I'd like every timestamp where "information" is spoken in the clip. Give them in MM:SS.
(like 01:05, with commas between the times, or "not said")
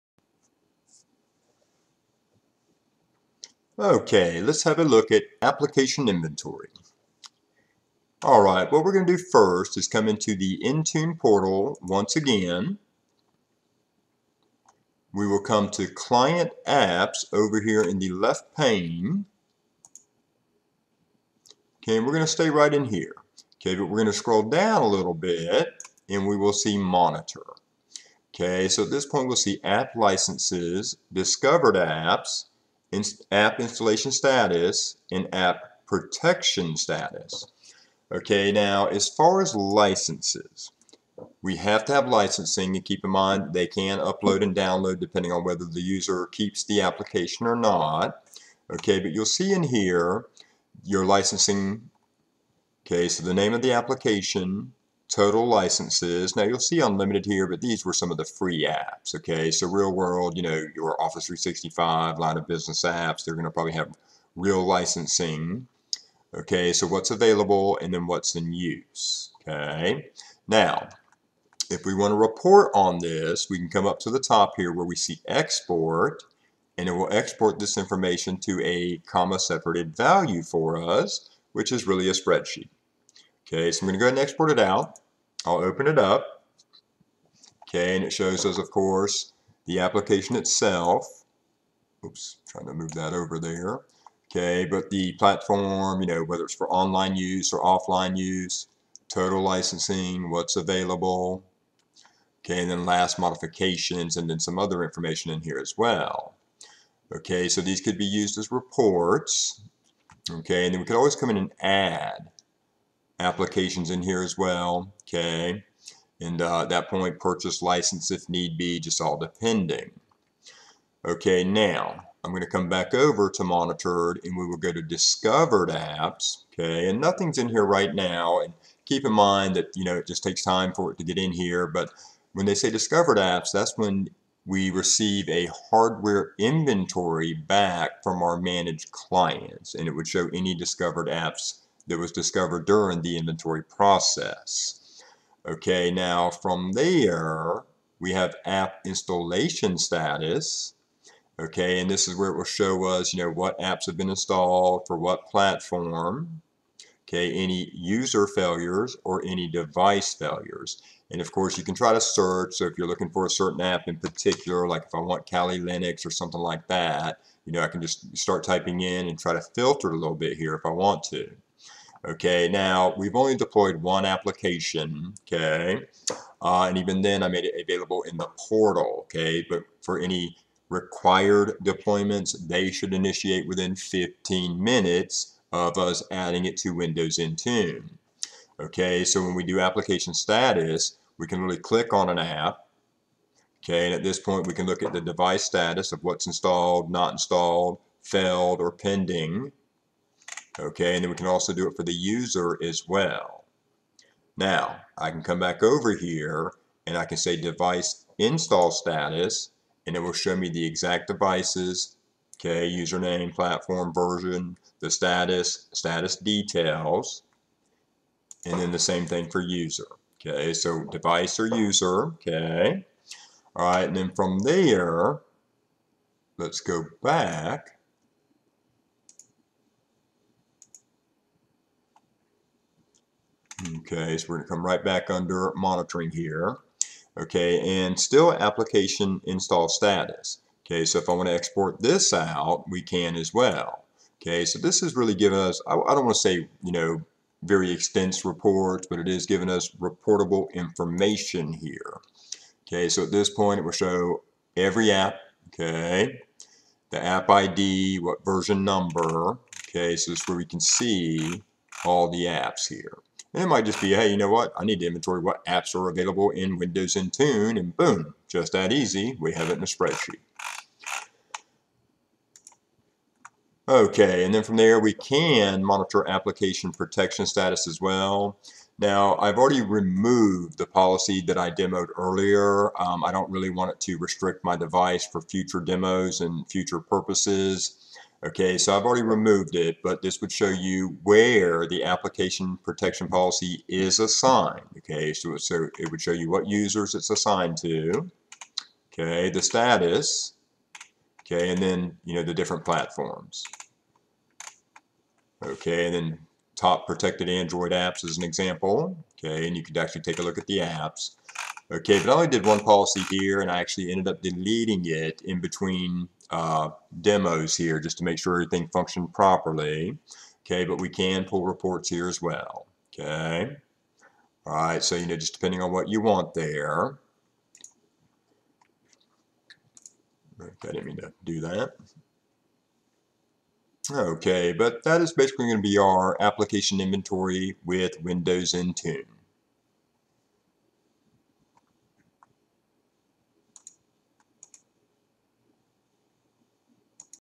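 01:17, 01:44, 04:10.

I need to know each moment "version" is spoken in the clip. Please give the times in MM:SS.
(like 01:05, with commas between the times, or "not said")
03:33, 04:18.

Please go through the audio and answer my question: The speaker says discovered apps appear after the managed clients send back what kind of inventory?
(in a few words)
Hardware inventory.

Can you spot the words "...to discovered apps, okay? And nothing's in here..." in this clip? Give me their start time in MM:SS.
02:04.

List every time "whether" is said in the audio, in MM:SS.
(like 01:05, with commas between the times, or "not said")
00:45, 01:36.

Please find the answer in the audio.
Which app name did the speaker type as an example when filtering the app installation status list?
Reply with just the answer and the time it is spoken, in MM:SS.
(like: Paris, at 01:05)
Kali Linux, at 02:45.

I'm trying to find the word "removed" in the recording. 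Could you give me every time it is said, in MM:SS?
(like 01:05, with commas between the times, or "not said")
04:39, 04:49.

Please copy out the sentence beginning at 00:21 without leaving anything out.
Okay, we're going to stay right in here.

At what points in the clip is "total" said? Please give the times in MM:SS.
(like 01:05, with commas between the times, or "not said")
00:55, 01:39.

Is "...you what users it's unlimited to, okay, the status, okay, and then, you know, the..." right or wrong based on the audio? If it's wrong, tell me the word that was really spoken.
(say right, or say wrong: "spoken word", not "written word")
wrong: "assigned", not "unlimited".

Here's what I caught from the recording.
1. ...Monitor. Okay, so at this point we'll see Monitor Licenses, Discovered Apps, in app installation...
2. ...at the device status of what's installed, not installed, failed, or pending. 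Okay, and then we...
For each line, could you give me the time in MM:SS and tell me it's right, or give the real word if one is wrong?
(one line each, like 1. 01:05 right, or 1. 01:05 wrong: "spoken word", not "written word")
1. 00:26 wrong: "App", not "Monitor"
2. 03:14 right.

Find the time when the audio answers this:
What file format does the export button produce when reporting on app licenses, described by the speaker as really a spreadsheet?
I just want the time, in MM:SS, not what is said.
01:18.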